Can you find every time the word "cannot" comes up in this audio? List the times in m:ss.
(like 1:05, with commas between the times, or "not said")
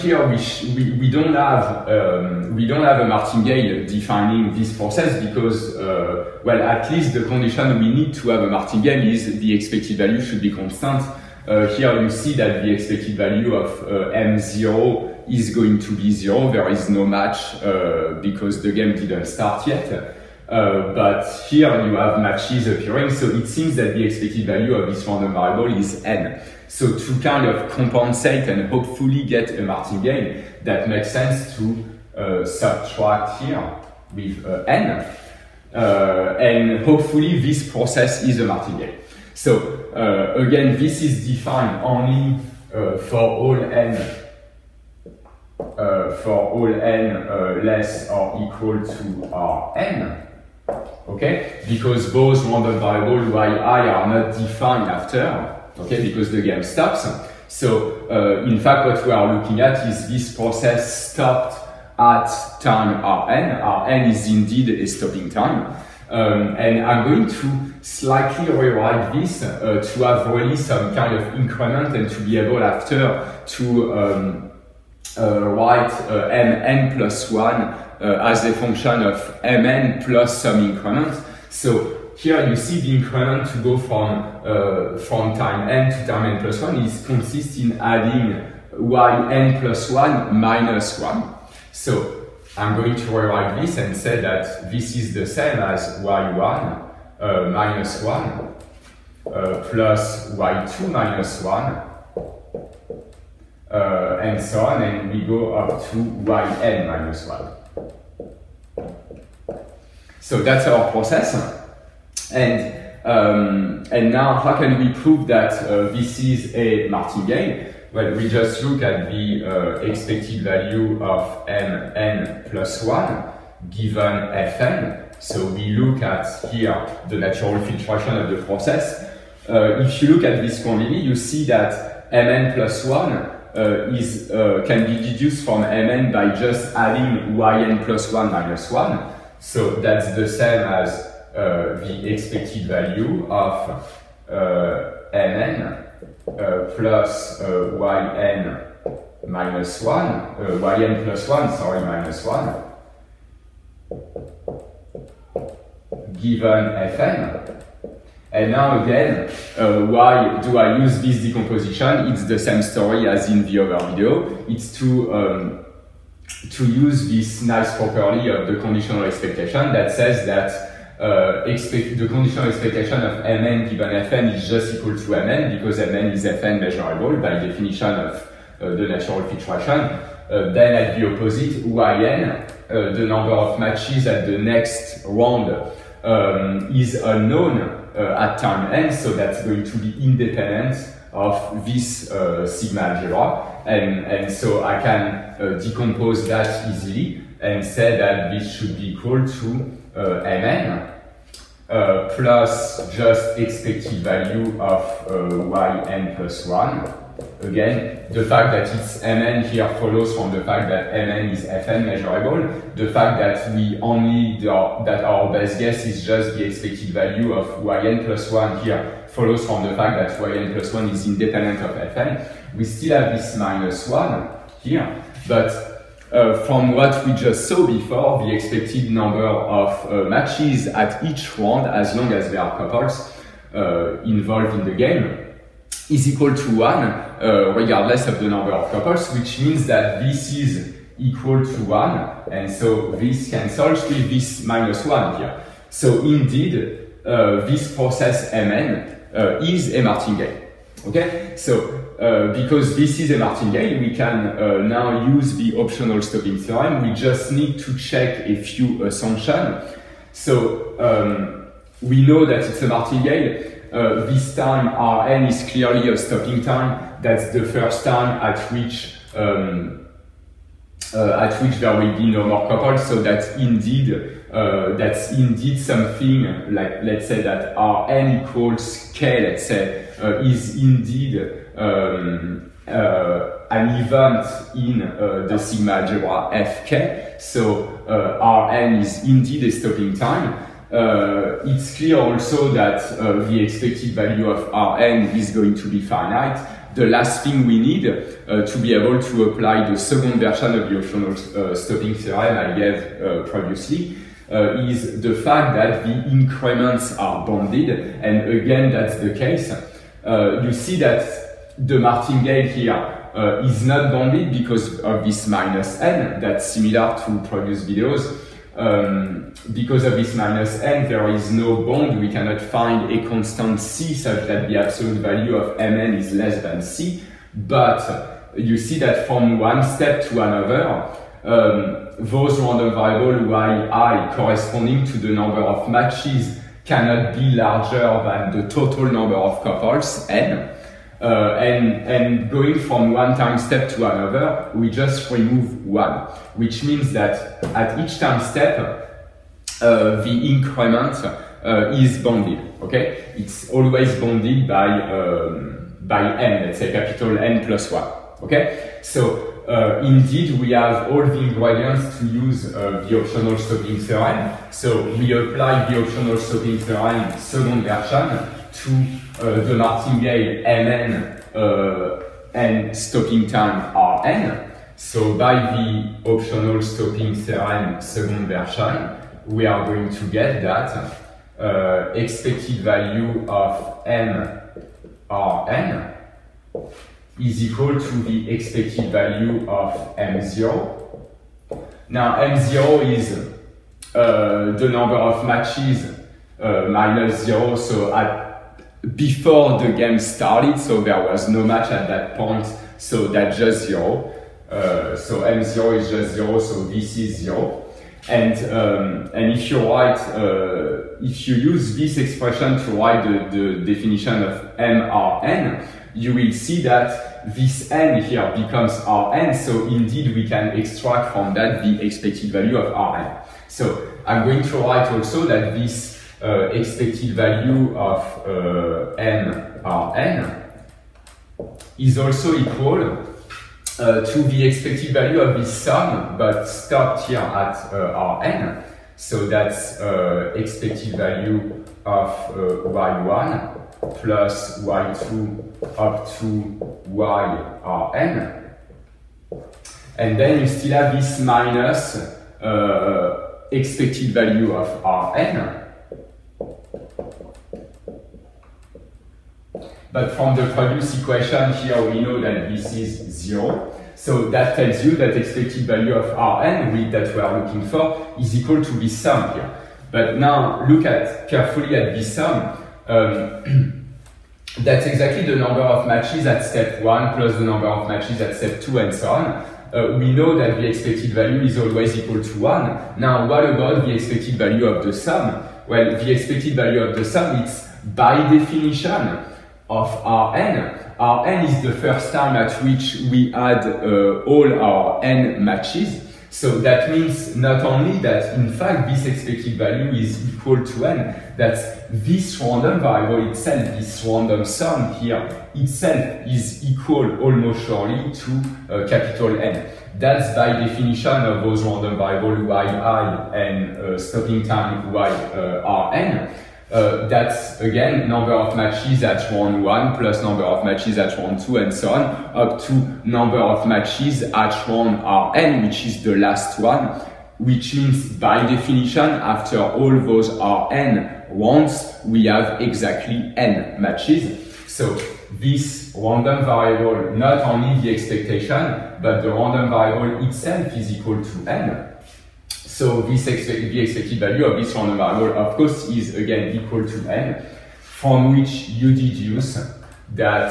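5:22, 5:36.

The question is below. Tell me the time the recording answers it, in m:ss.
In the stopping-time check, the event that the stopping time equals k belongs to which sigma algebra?
4:46.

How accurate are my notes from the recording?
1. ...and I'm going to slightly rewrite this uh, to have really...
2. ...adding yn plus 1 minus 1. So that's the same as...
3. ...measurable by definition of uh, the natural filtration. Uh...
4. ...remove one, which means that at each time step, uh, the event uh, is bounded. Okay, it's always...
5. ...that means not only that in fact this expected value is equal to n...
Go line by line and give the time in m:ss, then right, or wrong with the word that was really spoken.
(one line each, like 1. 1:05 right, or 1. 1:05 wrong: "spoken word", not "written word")
1. 1:06 right
2. 2:16 right
3. 2:56 right
4. 5:45 wrong: "increment", not "event"
5. 8:16 right.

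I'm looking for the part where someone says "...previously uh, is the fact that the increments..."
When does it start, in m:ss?
5:03.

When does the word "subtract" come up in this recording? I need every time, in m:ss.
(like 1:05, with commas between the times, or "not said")
0:32.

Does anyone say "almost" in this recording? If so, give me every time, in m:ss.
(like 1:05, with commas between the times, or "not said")
8:27.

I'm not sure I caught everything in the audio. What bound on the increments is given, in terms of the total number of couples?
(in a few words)
N plus one.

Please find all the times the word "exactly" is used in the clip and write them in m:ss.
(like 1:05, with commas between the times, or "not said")
7:54, 8:52.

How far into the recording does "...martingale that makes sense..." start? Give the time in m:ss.
0:29.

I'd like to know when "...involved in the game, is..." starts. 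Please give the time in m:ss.
3:54.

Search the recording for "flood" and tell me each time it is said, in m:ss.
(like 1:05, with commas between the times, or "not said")
not said.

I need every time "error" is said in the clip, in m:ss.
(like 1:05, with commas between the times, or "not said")
not said.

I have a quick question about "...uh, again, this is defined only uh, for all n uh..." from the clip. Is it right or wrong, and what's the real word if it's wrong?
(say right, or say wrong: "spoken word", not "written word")
right.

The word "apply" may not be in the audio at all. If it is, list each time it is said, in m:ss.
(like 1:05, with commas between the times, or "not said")
4:59, 6:05.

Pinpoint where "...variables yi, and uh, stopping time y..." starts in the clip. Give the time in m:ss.
8:31.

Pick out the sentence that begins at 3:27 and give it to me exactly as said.
Again, the fact that it's Mn here follows from the fact that Mn is Fn measurable.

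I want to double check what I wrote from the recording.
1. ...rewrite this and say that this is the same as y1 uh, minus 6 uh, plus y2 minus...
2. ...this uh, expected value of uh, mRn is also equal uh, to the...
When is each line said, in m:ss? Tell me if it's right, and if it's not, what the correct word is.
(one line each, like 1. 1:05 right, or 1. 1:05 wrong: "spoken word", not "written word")
1. 1:33 wrong: "1", not "6"
2. 7:05 right.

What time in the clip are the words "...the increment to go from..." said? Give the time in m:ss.
1:22.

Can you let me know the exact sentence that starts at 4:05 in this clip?
So indeed, uh, this process Mn is a martingale.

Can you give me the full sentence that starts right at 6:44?
Uh, so M0 is just zero, so this is zero.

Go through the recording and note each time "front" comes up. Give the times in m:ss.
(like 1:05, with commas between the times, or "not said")
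not said.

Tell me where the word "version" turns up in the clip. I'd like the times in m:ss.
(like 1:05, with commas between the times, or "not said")
5:00, 6:07, 6:18.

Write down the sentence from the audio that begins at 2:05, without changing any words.
So we look at here the natural filtration of the process.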